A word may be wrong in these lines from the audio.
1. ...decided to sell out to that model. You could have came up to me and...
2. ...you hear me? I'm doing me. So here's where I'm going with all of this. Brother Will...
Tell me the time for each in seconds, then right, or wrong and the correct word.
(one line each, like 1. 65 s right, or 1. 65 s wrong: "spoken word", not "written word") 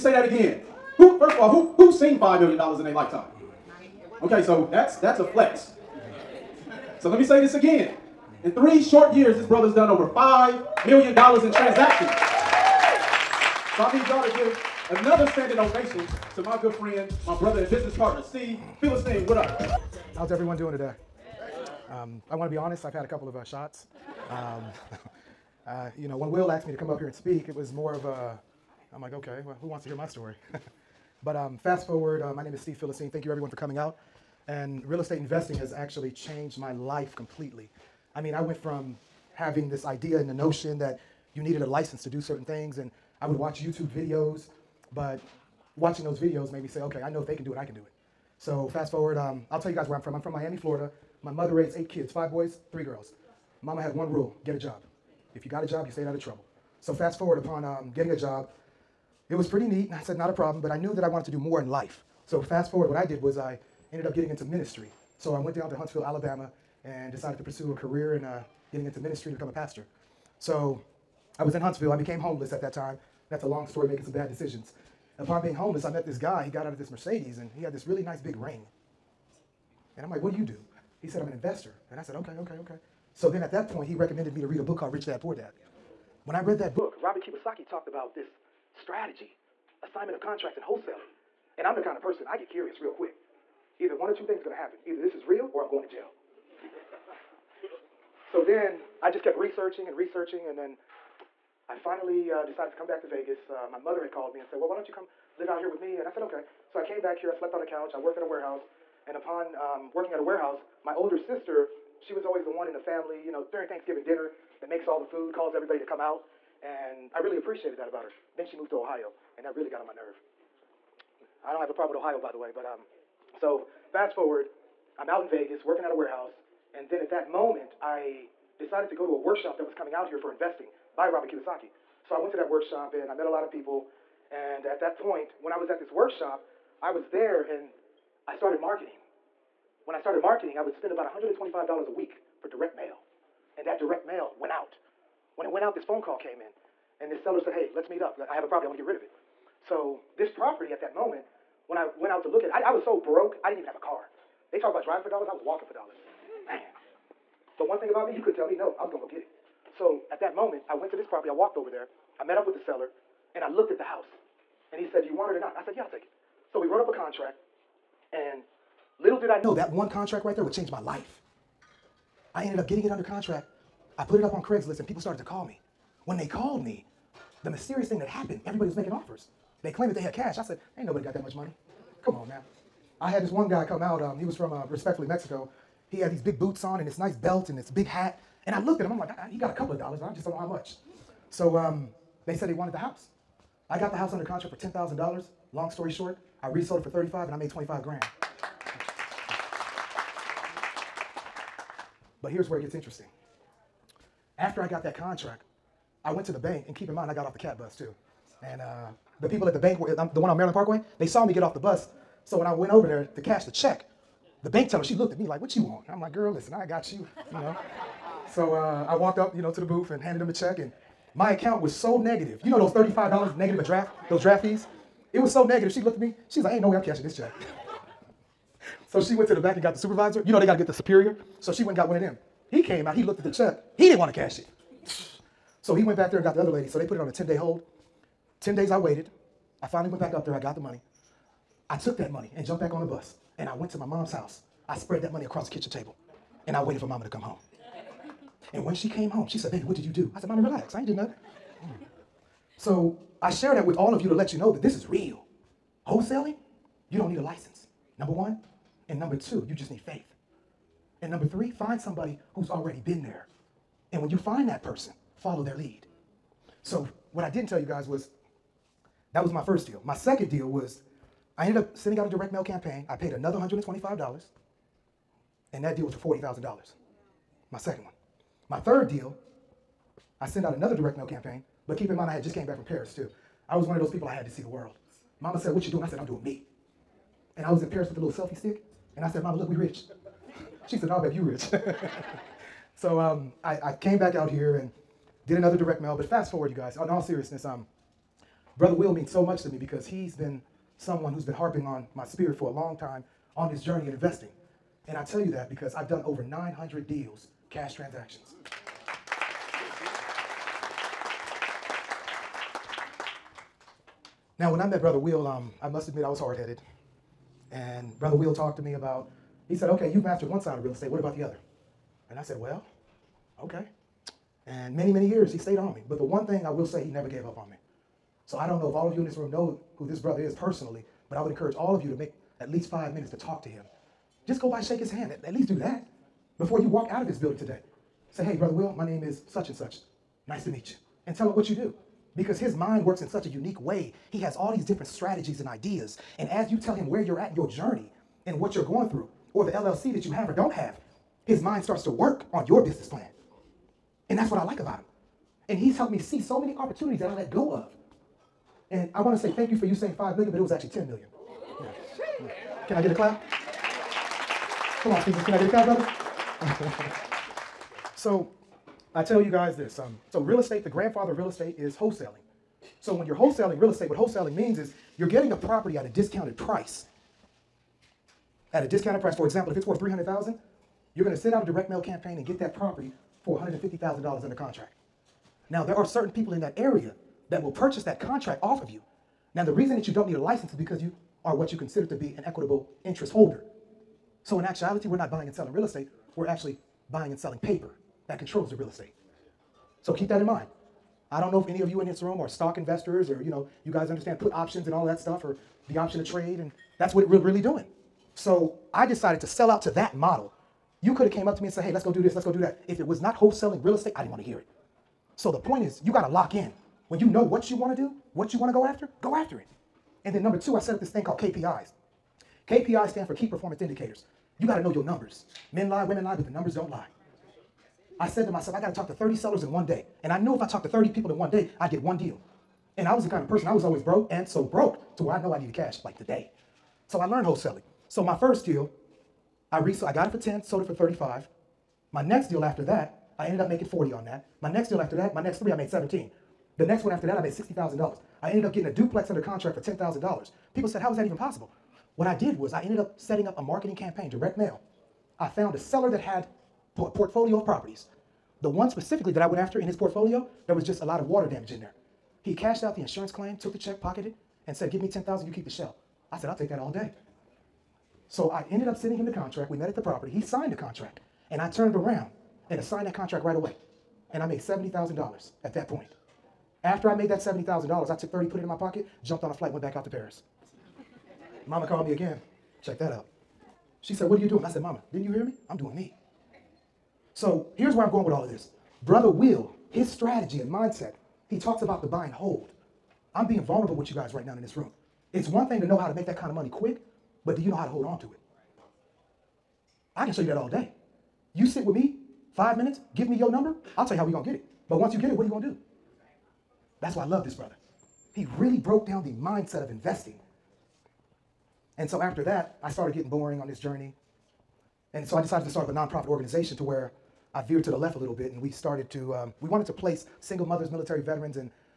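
1. 408 s right
2. 485 s right.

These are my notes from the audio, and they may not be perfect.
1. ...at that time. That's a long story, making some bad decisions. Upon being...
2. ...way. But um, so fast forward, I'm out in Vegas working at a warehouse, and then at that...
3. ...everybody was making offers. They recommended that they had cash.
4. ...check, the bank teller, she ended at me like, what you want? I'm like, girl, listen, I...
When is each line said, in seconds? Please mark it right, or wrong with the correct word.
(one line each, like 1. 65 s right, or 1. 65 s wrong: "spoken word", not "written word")
1. 72 s right
2. 122 s right
3. 178 s wrong: "claimed", not "recommended"
4. 213 s wrong: "looked", not "ended".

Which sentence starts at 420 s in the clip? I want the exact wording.
And then number two, I set up this thing called KPIs.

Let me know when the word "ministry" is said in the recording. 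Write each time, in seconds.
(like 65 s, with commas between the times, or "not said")
64 s, 68 s.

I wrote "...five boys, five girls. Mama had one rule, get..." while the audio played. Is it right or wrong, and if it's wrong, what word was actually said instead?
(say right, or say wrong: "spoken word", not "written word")
wrong: "three", not "five".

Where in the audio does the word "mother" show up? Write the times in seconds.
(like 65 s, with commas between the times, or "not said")
51 s, 103 s, 520 s.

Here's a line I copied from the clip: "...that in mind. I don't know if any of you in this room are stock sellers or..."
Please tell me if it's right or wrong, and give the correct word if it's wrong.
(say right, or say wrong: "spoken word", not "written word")
wrong: "investors", not "sellers".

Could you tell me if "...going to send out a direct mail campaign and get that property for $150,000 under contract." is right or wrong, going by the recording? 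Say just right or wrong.
right.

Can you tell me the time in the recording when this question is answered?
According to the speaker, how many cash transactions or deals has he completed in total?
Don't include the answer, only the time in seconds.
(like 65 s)
306 s.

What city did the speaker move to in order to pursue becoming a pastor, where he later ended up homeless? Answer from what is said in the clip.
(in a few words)
Huntsville, Alabama.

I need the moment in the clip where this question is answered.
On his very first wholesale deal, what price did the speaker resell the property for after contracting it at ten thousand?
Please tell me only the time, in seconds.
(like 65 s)
196 s.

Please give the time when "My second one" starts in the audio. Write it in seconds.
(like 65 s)
277 s.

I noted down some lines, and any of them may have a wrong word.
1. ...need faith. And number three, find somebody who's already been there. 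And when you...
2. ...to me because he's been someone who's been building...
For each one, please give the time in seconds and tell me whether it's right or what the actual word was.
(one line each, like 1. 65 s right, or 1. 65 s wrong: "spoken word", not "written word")
1. 259 s right
2. 299 s wrong: "harping", not "building".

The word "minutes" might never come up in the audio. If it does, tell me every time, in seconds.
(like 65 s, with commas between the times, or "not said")
332 s, 502 s.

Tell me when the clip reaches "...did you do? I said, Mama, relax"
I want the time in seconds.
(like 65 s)
249 s.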